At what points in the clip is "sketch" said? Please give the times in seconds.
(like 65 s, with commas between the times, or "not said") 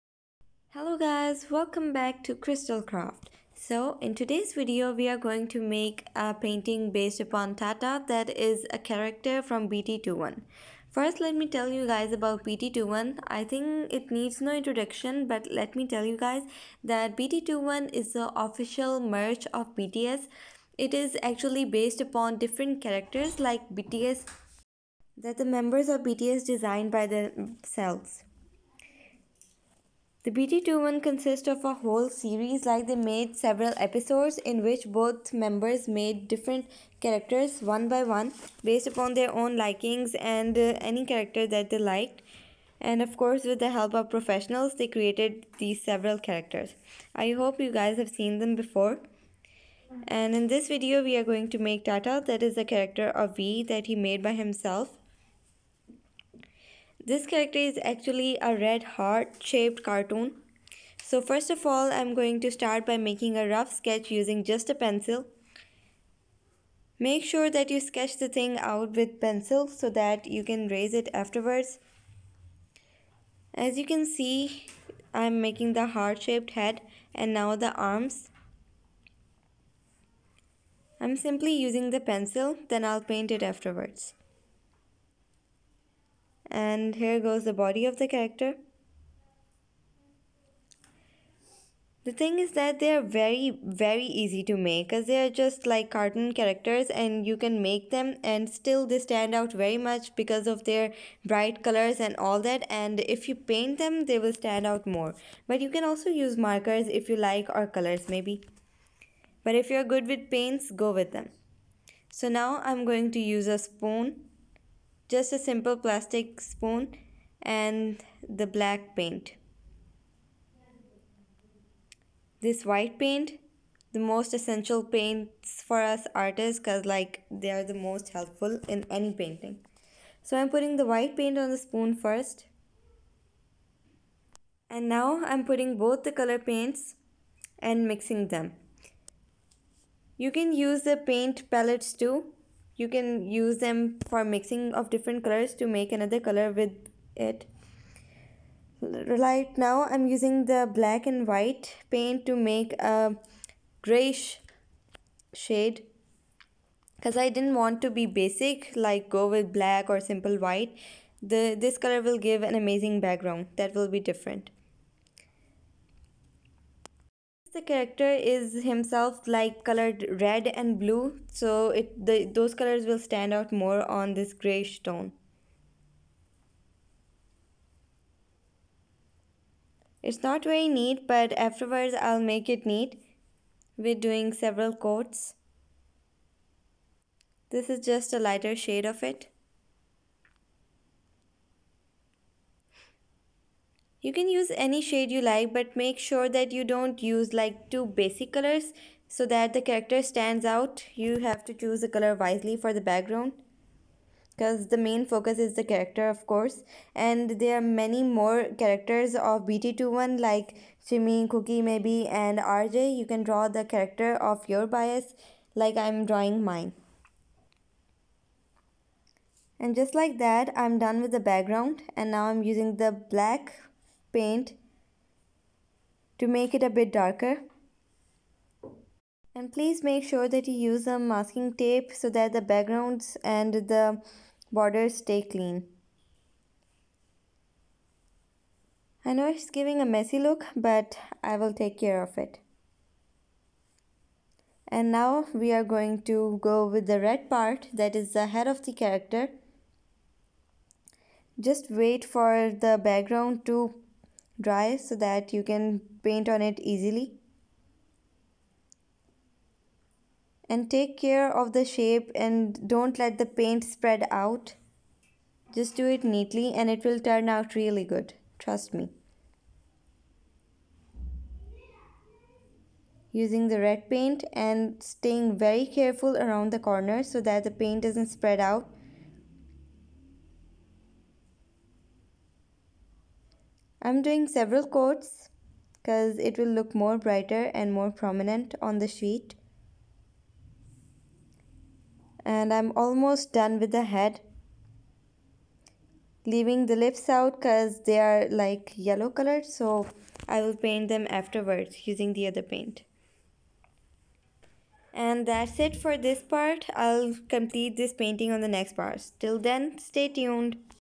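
63 s, 67 s.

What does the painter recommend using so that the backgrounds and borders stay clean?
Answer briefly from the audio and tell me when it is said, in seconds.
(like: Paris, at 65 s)
masking tape, at 230 s.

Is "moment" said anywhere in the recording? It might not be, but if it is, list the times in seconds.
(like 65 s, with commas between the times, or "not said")
not said.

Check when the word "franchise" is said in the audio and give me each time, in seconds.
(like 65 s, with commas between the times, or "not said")
not said.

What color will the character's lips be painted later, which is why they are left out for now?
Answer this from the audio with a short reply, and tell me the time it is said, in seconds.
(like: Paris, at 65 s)
yellow, at 298 s.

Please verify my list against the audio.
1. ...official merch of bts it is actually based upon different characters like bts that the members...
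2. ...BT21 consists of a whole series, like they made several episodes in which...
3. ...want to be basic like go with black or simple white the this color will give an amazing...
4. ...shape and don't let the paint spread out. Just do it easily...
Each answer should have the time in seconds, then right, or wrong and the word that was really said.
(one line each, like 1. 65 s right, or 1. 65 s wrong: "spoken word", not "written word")
1. 18 s right
2. 30 s right
3. 157 s right
4. 261 s wrong: "neatly", not "easily".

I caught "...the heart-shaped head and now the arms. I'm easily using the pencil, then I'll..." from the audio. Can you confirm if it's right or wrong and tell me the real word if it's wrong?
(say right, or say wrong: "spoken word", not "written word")
wrong: "simply", not "easily".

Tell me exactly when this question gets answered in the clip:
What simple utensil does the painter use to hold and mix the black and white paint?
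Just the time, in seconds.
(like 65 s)
115 s.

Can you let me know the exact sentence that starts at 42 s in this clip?
And of course, with the help of professionals, they created these several characters.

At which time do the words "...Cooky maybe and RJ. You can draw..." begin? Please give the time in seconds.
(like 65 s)
211 s.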